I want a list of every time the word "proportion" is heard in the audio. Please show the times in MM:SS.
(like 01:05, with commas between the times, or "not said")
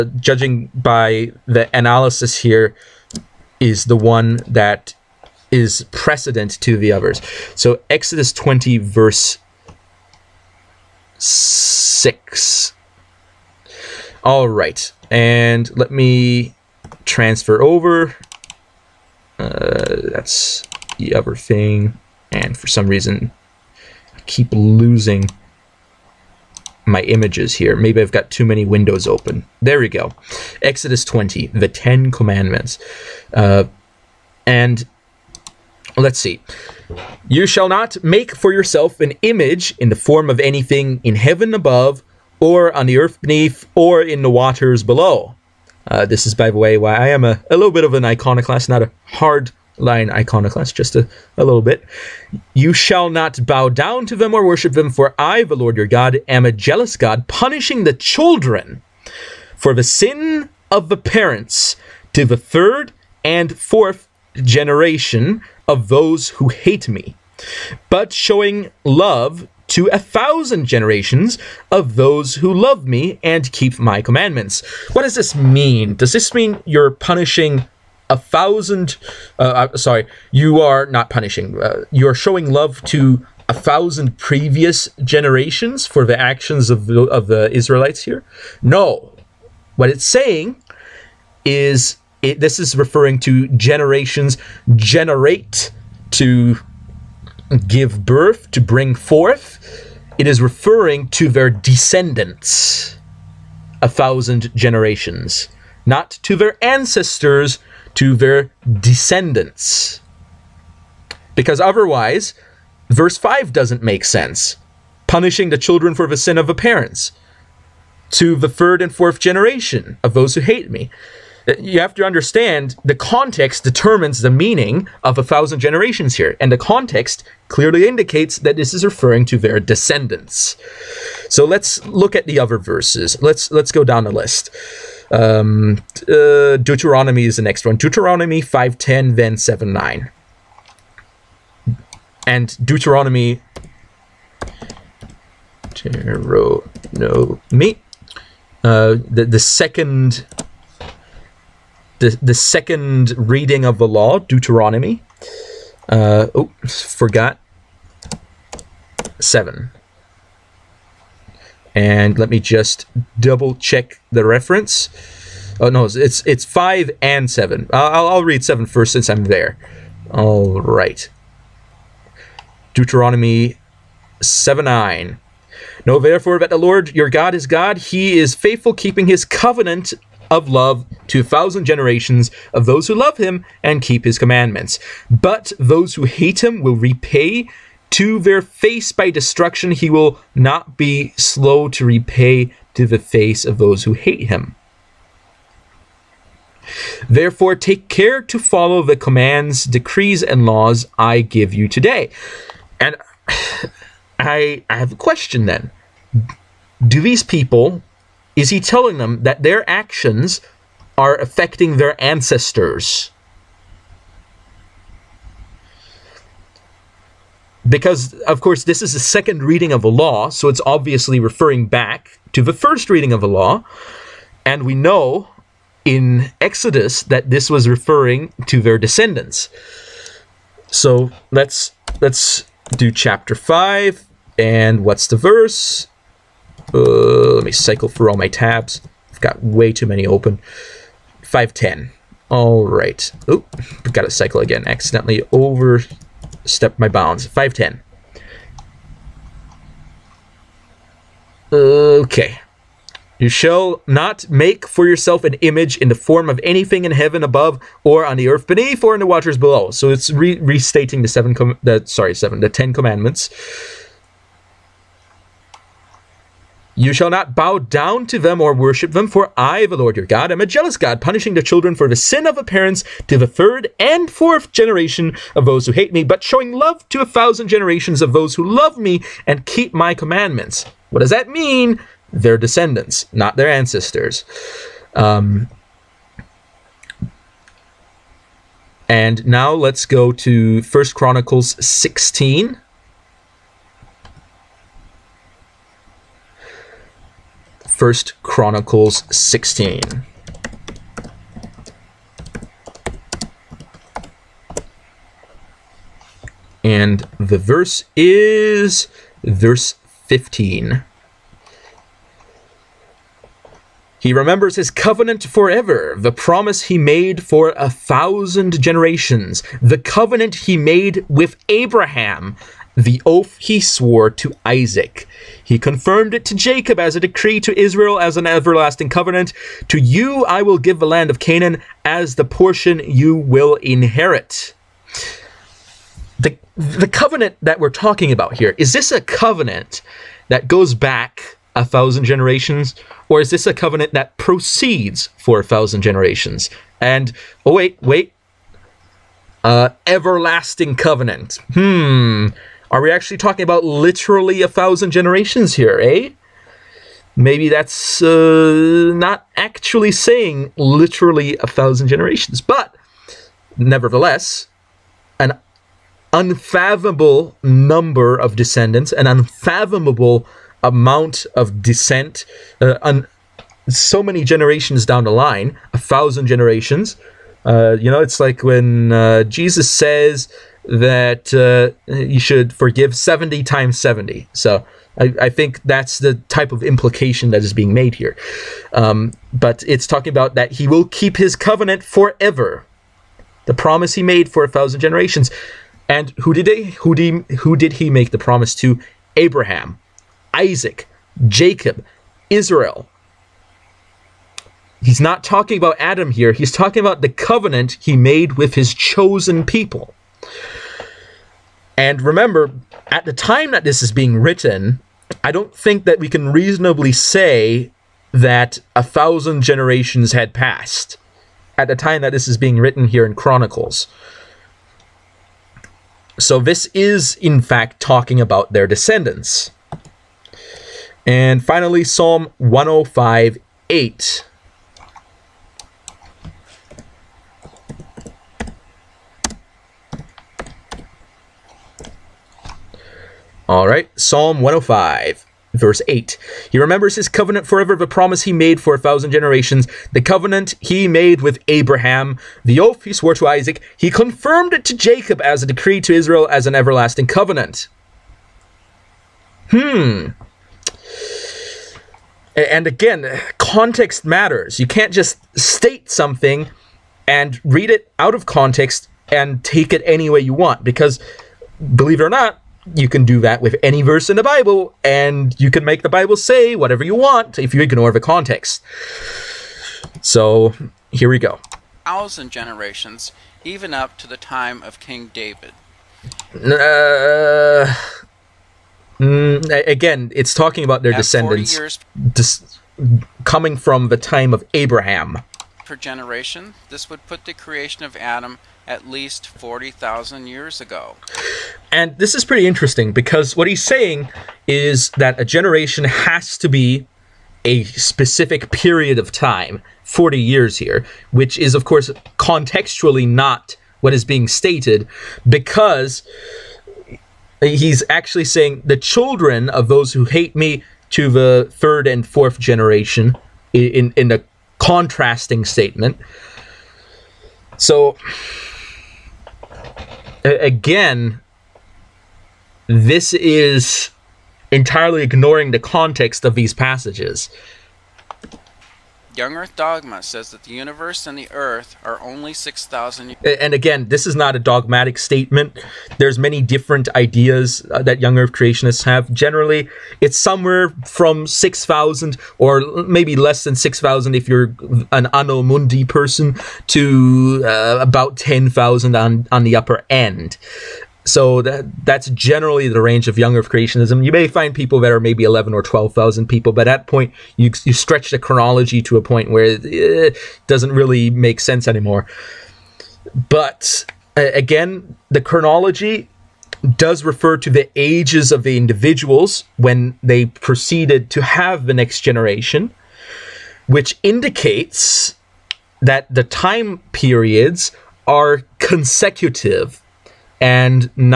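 not said.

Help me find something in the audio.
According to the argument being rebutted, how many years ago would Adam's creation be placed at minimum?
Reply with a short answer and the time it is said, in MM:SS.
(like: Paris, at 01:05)
40,000 years, at 08:19.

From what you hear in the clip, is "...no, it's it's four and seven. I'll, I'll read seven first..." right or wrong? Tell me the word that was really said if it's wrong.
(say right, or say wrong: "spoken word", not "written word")
wrong: "five", not "four".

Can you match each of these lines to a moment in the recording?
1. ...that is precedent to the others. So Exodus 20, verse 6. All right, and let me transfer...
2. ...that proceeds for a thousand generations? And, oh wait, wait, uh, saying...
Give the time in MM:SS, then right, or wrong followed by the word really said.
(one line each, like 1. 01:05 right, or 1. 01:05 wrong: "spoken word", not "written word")
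1. 00:04 right
2. 05:43 wrong: "everlasting", not "saying".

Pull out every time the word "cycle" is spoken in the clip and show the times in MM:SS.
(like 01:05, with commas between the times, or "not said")
03:57, 04:04.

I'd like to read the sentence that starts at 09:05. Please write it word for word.
There's many different ideas uh, that young earth creationists have.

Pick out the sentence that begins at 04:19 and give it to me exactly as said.
So it's re- restating the seven, com- the, sorry, seven, the Ten Commandments.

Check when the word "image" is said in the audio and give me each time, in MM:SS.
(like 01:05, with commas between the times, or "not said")
00:27, 00:39, 04:15.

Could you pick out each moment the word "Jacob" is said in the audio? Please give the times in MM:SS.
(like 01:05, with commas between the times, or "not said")
05:26, 06:41, 07:34.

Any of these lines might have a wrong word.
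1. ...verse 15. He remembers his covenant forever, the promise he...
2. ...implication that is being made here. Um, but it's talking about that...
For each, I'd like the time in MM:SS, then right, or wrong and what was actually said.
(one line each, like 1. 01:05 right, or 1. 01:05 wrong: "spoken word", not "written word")
1. 05:09 right
2. 06:26 right.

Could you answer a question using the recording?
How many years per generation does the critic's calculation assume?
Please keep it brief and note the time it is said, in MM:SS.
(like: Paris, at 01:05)
40 years, at 08:29.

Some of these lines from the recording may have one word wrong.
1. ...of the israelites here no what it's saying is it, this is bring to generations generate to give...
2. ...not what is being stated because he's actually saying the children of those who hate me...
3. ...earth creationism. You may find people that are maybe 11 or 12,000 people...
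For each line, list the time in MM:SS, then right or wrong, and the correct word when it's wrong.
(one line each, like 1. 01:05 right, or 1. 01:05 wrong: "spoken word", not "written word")
1. 01:27 wrong: "referring", not "bring"
2. 08:33 right
3. 09:23 right.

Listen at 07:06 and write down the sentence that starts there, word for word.
So this is, in fact, talking about their descendants.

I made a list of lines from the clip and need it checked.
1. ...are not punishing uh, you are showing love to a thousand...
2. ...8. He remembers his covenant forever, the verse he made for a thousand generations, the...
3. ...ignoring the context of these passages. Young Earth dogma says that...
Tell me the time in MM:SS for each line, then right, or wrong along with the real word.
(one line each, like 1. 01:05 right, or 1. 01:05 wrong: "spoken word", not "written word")
1. 01:20 right
2. 07:25 wrong: "promise", not "verse"
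3. 08:55 right.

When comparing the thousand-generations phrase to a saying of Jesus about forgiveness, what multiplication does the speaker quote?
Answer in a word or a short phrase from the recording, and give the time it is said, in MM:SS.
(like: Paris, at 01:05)
70 times 70, at 06:22.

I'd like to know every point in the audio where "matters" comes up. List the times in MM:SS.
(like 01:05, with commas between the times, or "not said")
07:44.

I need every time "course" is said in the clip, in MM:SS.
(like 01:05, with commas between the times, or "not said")
03:38, 08:31.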